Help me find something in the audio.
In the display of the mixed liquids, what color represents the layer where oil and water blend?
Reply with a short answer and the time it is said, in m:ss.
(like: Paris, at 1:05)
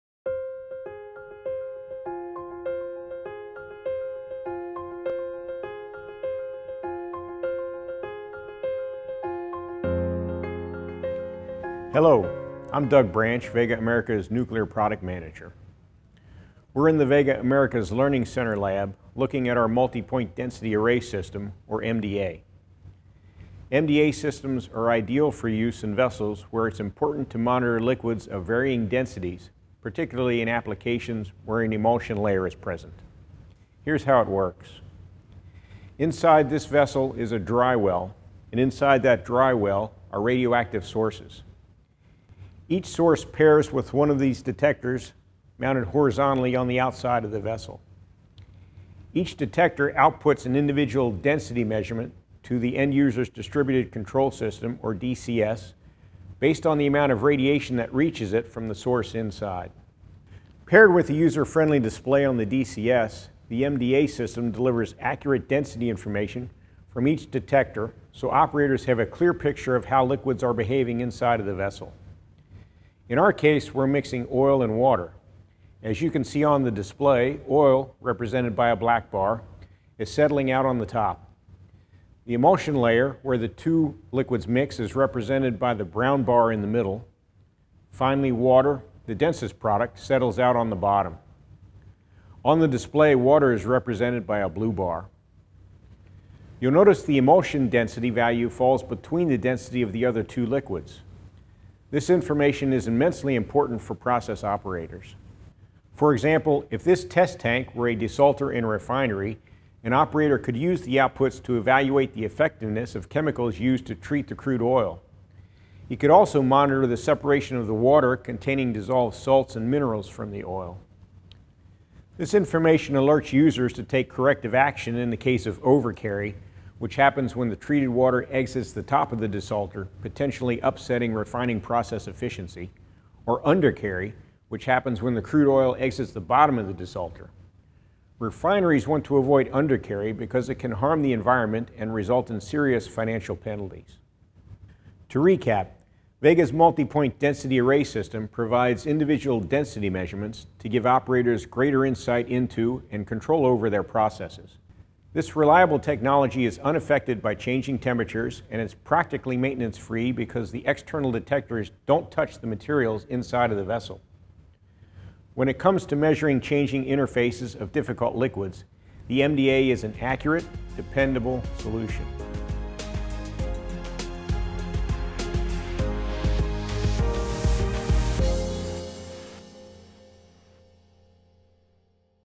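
Brown, at 1:25.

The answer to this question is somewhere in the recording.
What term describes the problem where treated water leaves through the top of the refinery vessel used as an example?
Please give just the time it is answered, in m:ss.
2:05.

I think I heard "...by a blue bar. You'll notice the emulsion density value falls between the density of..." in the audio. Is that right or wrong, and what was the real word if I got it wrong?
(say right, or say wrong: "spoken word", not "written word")
right.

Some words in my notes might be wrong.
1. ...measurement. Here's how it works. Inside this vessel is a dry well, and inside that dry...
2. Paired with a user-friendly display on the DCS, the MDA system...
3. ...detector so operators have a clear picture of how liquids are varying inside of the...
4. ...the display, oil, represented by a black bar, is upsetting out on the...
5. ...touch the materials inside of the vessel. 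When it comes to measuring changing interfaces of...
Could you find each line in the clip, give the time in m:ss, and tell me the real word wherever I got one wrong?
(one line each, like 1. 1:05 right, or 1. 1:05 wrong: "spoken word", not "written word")
1. 0:32 wrong: "present", not "measurement"
2. 1:00 right
3. 1:07 wrong: "behaving", not "varying"
4. 1:16 wrong: "settling", not "upsetting"
5. 2:42 right.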